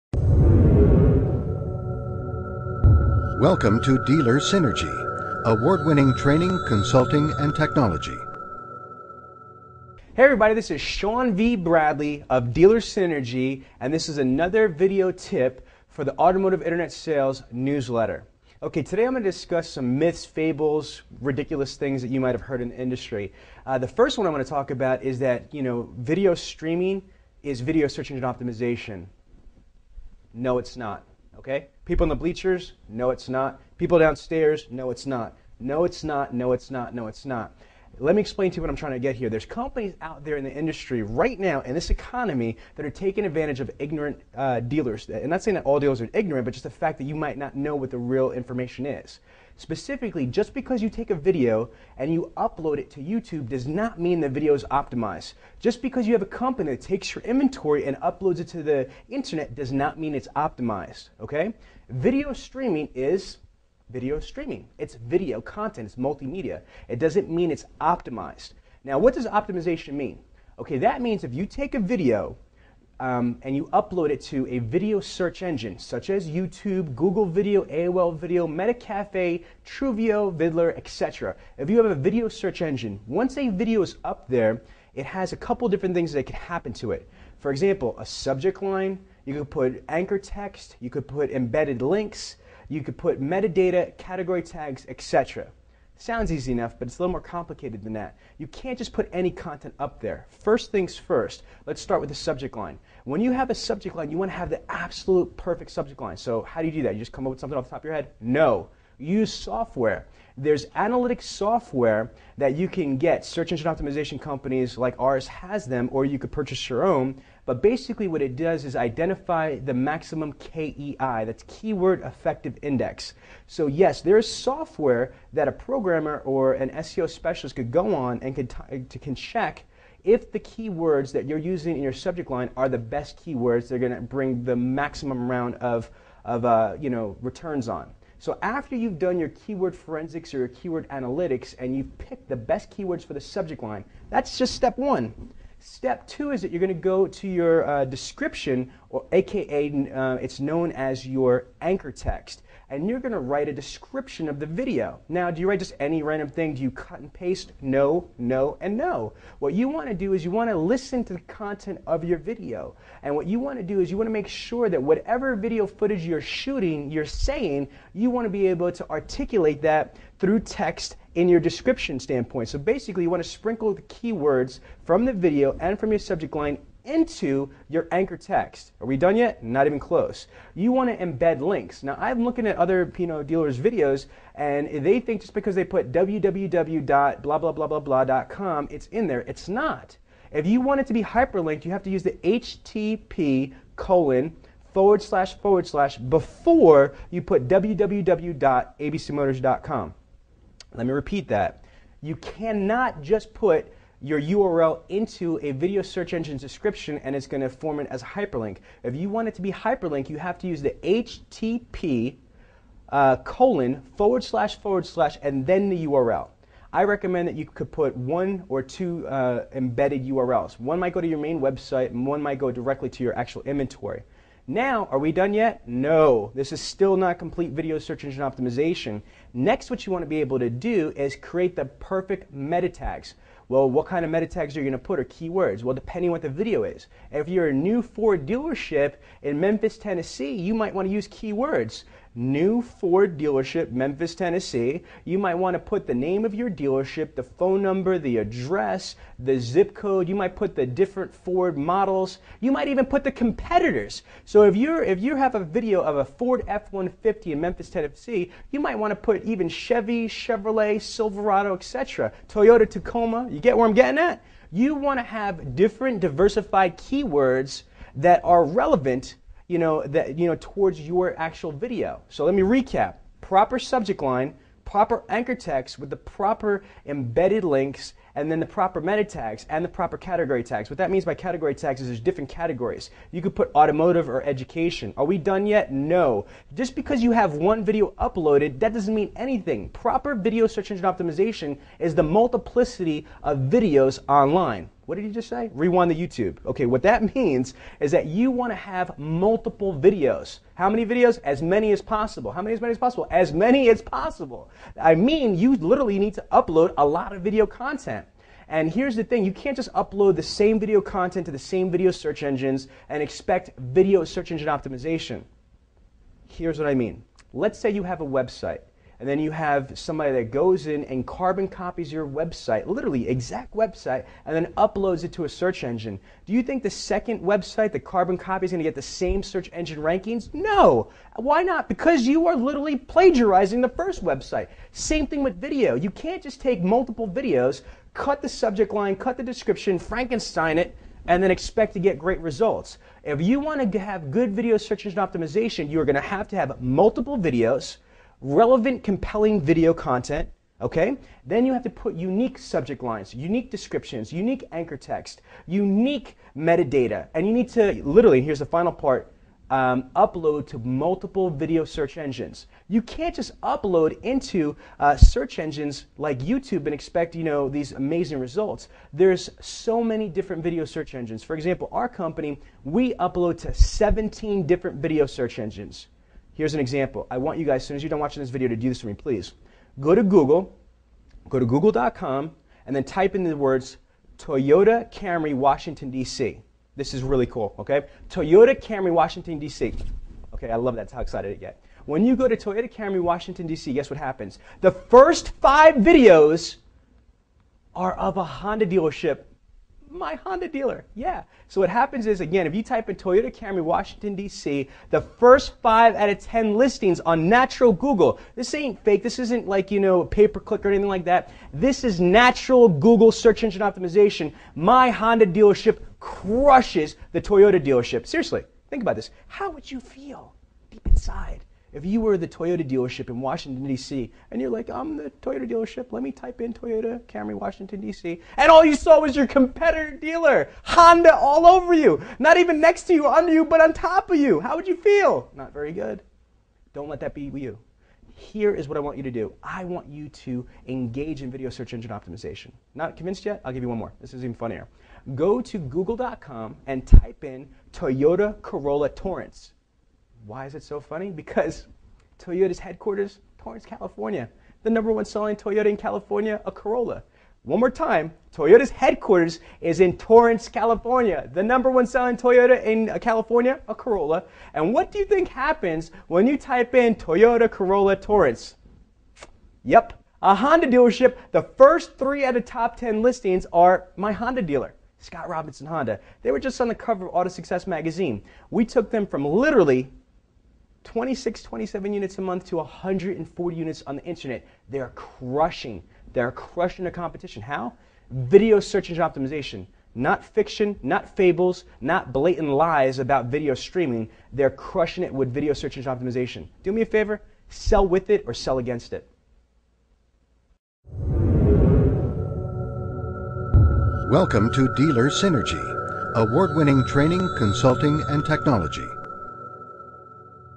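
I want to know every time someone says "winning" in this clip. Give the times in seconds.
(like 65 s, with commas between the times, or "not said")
5 s, 506 s.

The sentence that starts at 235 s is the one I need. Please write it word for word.
Well, depending what the video is.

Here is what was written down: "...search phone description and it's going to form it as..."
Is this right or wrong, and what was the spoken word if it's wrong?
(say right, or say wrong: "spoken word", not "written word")
wrong: "engine", not "phone".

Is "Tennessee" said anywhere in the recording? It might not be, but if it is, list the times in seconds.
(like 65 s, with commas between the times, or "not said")
239 s, 244 s, 257 s.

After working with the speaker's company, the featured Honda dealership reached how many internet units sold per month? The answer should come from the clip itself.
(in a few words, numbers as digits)
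140.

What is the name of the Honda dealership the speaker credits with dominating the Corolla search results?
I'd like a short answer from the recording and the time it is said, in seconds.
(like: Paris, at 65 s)
Scott Robinson Honda, at 474 s.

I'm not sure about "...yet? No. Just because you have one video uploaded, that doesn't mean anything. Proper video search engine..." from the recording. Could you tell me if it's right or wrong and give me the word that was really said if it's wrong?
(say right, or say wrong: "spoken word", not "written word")
right.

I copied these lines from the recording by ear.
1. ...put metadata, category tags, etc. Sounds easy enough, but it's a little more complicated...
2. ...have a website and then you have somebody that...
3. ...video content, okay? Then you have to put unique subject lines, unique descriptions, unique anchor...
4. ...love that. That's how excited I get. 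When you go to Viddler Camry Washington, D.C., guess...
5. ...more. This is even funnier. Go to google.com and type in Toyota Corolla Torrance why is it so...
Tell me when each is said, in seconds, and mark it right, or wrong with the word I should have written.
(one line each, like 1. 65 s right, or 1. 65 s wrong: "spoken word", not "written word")
1. 92 s right
2. 317 s right
3. 349 s right
4. 390 s wrong: "Toyota", not "Viddler"
5. 443 s right.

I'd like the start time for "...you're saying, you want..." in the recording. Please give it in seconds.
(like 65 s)
166 s.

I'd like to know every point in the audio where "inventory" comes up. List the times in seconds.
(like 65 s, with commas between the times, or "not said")
57 s, 223 s.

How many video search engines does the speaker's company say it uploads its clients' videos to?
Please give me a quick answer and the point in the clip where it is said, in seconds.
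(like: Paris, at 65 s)
17, at 373 s.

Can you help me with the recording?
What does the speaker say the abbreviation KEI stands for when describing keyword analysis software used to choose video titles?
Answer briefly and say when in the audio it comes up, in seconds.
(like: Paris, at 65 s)
keyword effective index, at 121 s.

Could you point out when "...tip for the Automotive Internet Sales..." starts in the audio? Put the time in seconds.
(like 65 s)
15 s.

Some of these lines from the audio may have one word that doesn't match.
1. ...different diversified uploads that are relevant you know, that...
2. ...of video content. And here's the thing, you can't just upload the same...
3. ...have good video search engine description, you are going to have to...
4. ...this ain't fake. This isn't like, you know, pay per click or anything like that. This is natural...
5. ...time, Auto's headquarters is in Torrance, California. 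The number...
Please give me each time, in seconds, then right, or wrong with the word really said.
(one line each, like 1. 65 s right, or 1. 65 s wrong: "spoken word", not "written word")
1. 265 s wrong: "keywords", not "uploads"
2. 307 s right
3. 343 s wrong: "optimization", not "description"
4. 408 s right
5. 457 s wrong: "Toyota", not "Auto".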